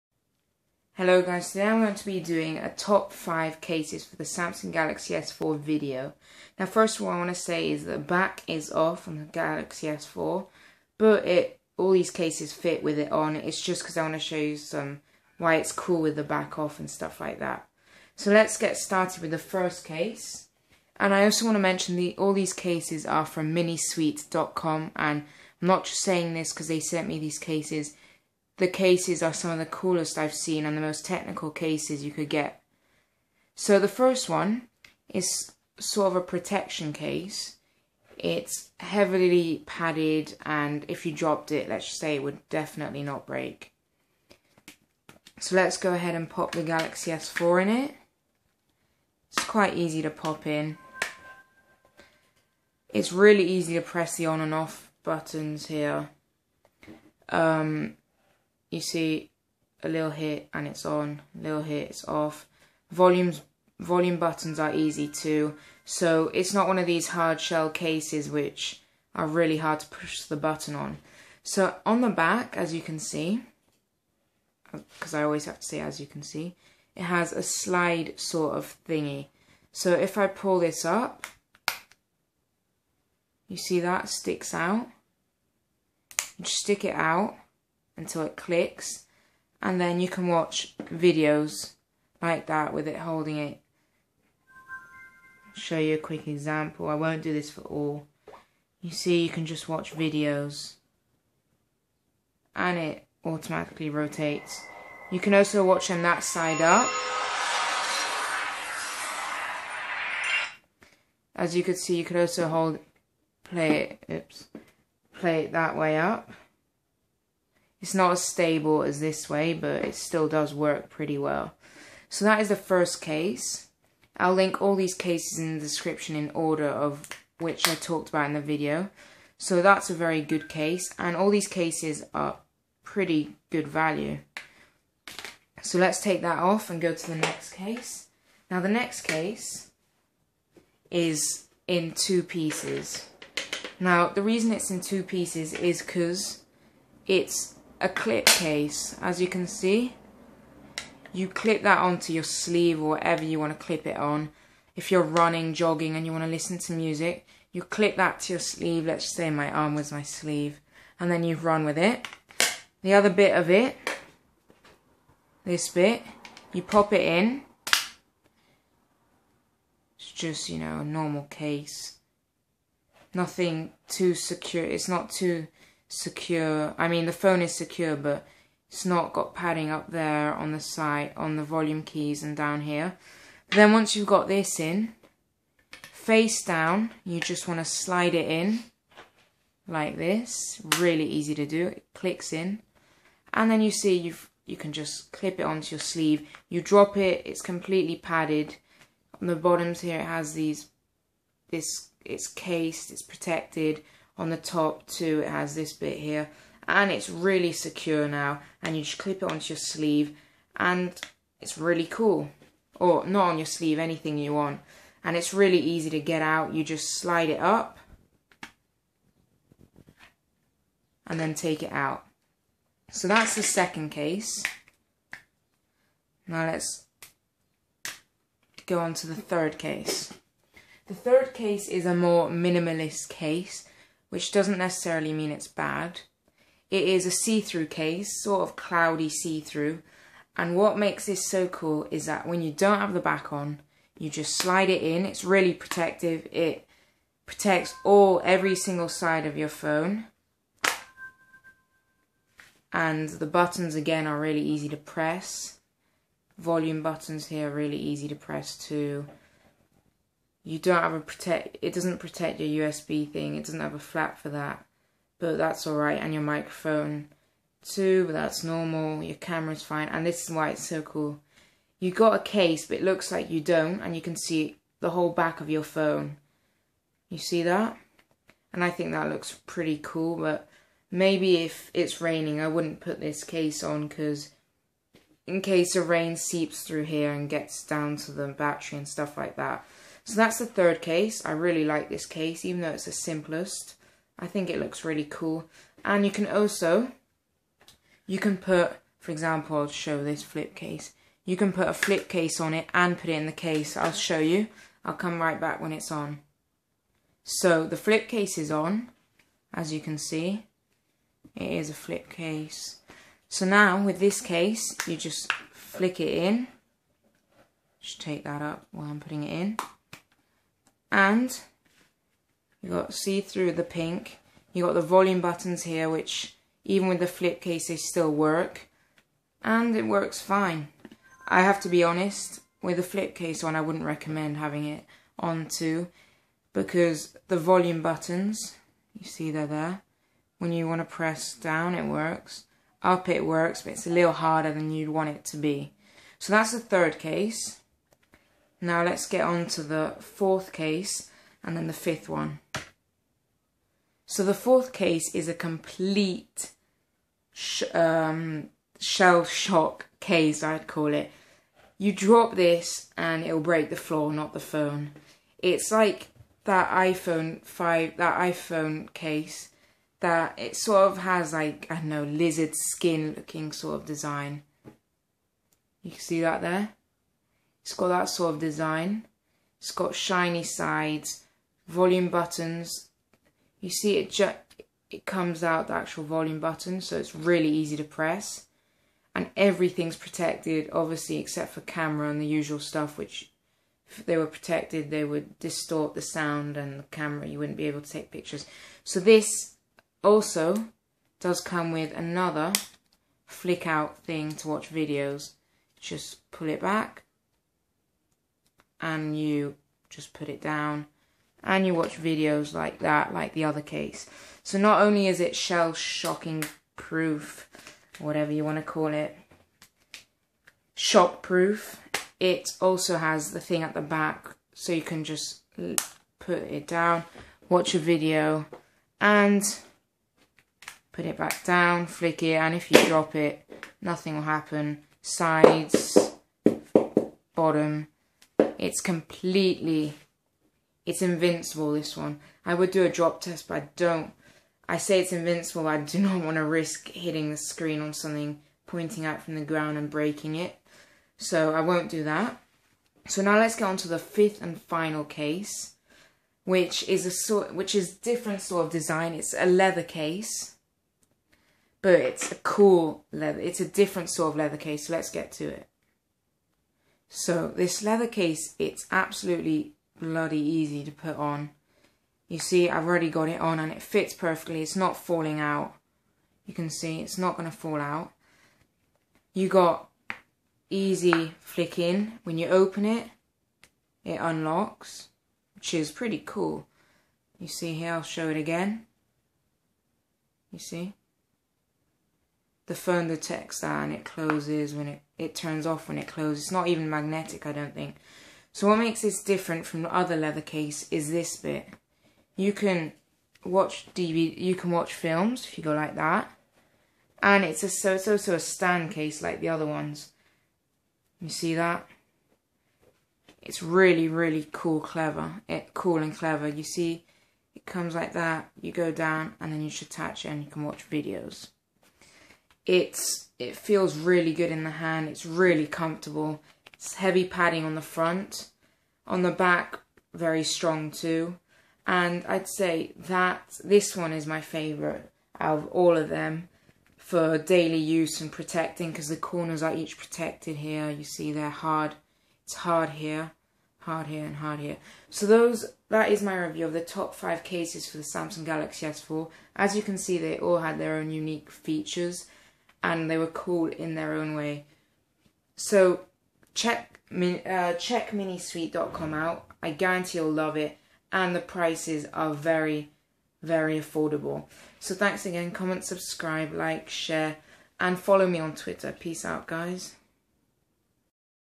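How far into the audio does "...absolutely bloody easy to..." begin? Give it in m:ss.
7:48.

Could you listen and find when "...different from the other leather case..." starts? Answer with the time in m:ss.
8:19.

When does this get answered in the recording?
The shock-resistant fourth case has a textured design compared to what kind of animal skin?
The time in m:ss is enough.
6:12.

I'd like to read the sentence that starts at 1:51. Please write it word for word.
As you could see, you could also hold, play it, oops, play it that way up.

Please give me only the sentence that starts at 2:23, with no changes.
Now the reason it's in two pieces is because it's a clip case, as you can see.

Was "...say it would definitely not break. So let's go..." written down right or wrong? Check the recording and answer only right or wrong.
right.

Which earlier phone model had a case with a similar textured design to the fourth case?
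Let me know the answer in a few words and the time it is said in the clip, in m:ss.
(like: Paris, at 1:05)
iPhone 5, at 6:06.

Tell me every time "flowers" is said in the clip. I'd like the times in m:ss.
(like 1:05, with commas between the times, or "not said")
not said.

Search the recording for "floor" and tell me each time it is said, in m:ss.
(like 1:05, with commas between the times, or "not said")
6:03.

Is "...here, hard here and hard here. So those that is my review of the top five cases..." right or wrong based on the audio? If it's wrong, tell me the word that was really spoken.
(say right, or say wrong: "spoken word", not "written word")
right.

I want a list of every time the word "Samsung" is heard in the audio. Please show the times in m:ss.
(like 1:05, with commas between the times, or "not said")
0:04, 9:08.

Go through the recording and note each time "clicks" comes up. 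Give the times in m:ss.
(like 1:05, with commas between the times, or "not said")
1:28, 3:11.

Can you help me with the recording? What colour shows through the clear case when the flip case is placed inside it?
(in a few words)
pink.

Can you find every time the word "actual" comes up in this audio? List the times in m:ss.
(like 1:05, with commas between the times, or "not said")
6:25.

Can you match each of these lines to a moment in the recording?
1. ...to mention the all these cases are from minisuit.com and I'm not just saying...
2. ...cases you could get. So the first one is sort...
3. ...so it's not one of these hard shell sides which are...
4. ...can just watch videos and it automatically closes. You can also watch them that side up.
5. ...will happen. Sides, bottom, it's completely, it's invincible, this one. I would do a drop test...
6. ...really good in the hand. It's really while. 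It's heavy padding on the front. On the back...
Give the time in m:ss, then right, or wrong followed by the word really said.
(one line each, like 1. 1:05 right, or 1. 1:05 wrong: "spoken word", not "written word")
1. 0:21 right
2. 0:31 right
3. 1:05 wrong: "cases", not "sides"
4. 1:39 wrong: "rotates", not "closes"
5. 7:14 right
6. 8:43 wrong: "comfortable", not "while".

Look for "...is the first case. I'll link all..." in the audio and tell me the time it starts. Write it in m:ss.
2:02.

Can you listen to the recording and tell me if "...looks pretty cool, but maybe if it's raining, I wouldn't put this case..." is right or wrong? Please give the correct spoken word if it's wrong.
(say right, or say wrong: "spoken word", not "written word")
right.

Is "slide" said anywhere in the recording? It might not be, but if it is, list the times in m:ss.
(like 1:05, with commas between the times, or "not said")
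1:17, 3:07, 3:36, 4:04.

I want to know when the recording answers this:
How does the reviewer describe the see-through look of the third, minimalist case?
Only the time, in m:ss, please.
3:58.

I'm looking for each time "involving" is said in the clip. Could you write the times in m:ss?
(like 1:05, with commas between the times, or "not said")
not said.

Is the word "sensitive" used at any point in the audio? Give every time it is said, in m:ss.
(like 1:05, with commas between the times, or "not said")
not said.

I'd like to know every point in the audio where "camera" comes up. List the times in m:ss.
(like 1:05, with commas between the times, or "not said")
4:29, 6:31, 6:36.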